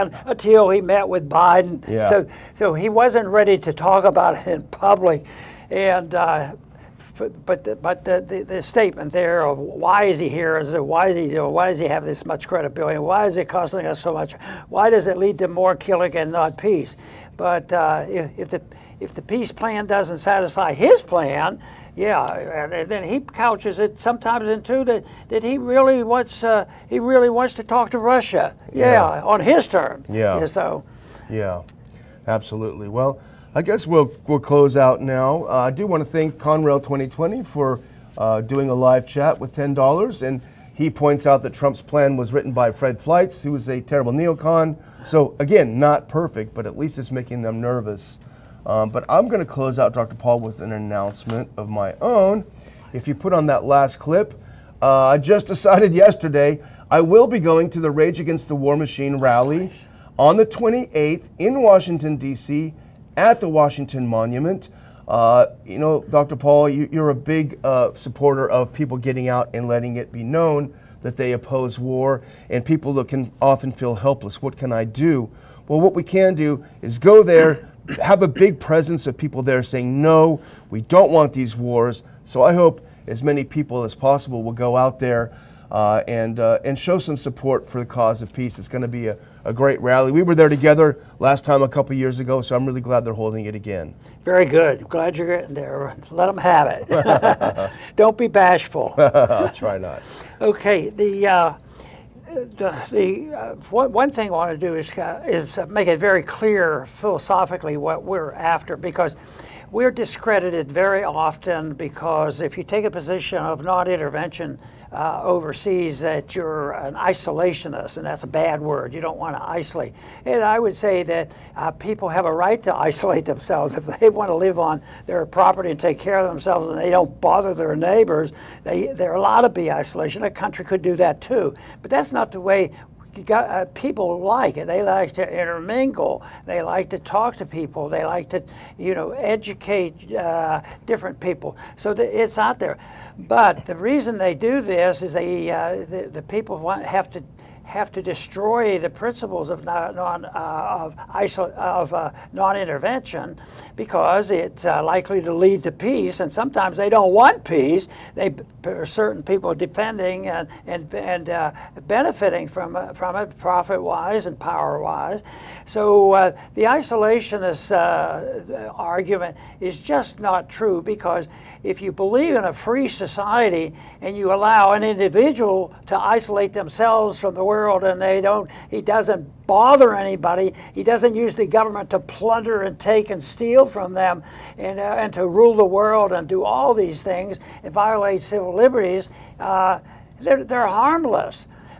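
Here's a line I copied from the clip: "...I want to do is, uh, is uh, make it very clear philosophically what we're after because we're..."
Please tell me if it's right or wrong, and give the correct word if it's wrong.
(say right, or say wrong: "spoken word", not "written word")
right.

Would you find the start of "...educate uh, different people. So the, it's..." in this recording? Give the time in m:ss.
2:19.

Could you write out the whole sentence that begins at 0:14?
Why does it lead to more killing and not peace?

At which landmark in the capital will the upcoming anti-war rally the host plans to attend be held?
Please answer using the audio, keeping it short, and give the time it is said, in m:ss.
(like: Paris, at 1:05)
Washington Monument, at 1:03.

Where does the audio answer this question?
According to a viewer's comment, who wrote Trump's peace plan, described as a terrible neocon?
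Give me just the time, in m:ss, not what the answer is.
0:42.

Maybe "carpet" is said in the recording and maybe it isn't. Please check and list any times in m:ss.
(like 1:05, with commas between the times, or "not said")
not said.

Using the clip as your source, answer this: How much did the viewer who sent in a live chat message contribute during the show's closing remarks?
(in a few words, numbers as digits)
$10.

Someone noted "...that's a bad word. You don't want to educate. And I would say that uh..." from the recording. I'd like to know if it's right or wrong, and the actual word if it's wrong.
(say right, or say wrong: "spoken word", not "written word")
wrong: "isolate", not "educate".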